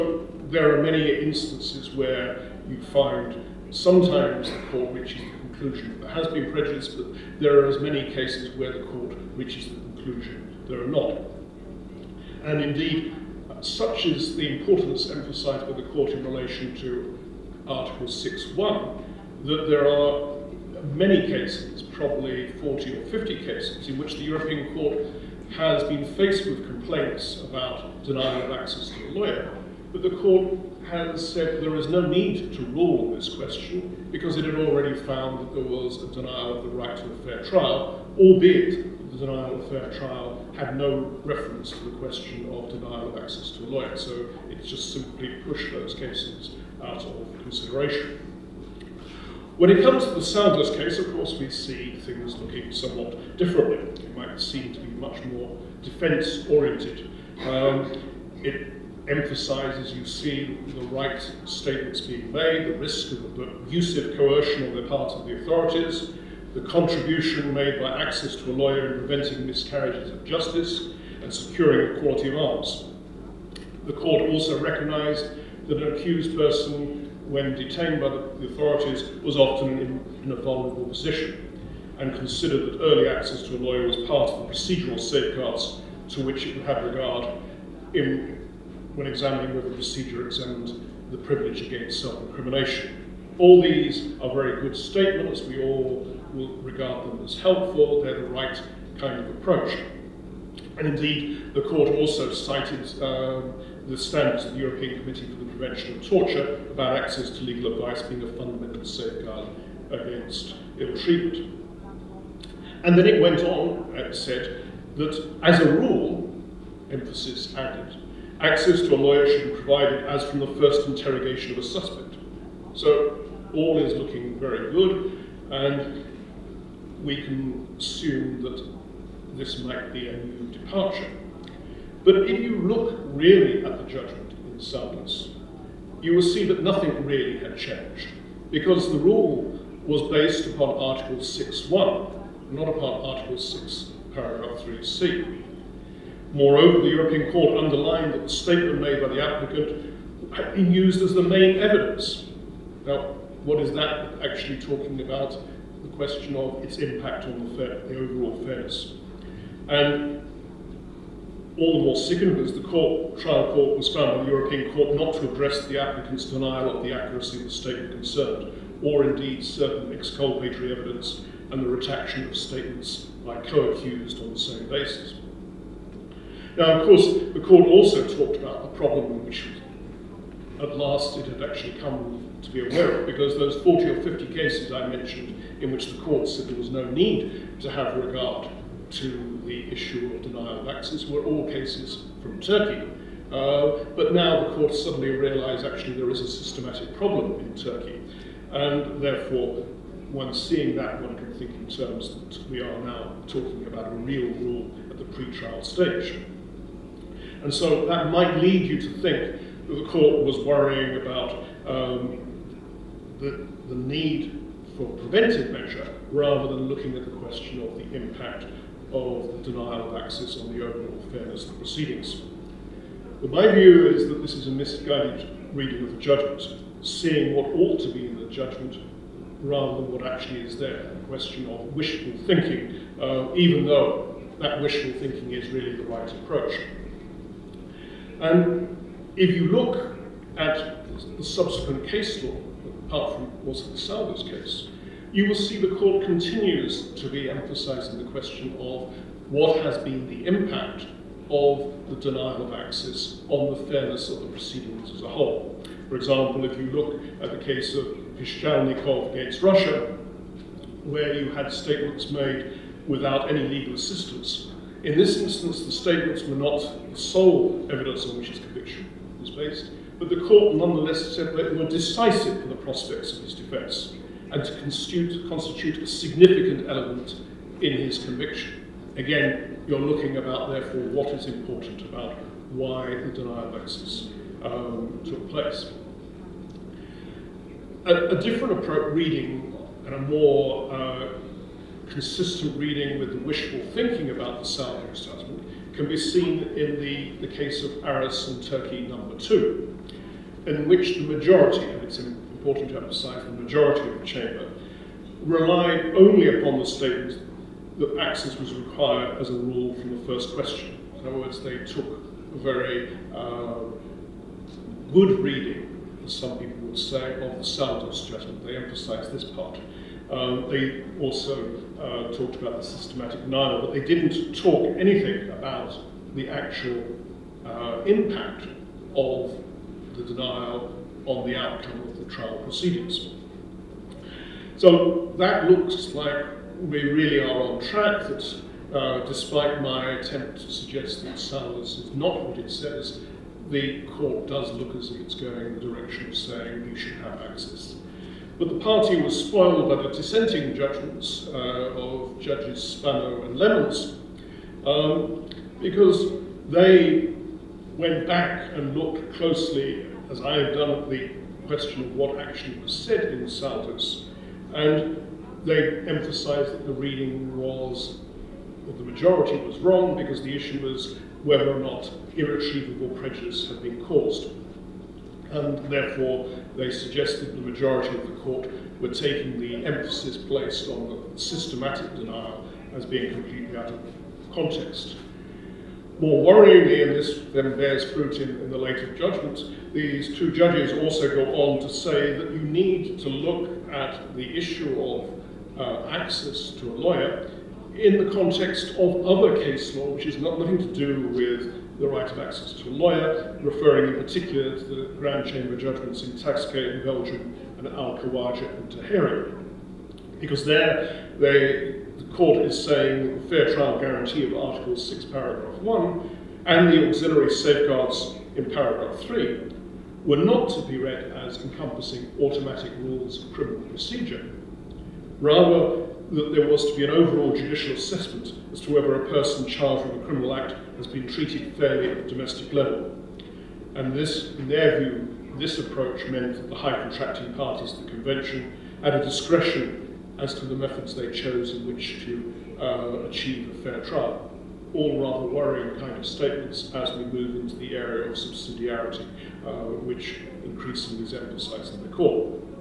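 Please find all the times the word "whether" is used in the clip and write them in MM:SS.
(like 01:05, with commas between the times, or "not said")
01:29, 06:11, 07:08.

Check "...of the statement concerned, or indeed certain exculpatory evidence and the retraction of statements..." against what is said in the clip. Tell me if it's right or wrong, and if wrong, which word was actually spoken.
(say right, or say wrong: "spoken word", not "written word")
right.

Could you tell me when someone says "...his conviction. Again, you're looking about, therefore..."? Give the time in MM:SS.
04:37.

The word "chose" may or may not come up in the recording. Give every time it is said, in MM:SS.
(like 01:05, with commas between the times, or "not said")
07:21.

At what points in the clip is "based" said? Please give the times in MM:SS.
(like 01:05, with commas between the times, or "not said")
02:20, 04:29.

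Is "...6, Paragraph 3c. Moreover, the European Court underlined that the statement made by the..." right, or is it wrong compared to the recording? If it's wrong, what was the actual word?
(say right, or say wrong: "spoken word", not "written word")
right.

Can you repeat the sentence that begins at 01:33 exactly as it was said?
All these are very good statements.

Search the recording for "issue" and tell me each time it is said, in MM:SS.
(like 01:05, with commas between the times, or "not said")
03:09, 06:10, 06:34.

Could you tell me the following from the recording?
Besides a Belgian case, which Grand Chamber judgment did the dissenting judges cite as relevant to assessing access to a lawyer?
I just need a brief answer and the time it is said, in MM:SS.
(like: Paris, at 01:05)
Al-Khawaja and Tahery, at 06:47.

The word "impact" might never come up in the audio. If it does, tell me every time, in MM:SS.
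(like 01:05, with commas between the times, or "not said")
02:36, 03:37, 04:10, 05:27.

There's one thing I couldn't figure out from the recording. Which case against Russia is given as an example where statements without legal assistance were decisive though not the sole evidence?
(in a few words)
Pishchalnikov.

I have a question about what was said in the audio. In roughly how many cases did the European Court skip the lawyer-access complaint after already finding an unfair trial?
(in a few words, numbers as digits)
40 or 50.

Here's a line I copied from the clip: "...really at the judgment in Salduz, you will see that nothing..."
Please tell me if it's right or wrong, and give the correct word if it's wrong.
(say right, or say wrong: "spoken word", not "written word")
right.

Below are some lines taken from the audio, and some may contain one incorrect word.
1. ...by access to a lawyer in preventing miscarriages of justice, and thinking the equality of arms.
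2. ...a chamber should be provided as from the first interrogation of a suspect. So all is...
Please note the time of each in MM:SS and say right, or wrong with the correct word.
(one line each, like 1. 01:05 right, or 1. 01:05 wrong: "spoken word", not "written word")
1. 01:07 wrong: "securing", not "thinking"
2. 01:58 wrong: "lawyer", not "chamber".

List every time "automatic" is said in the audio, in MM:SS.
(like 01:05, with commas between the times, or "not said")
07:02.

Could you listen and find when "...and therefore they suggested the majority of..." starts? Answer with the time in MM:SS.
06:15.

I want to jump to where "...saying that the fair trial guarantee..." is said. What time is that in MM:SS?
06:52.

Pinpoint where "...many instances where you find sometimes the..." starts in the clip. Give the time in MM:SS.
00:00.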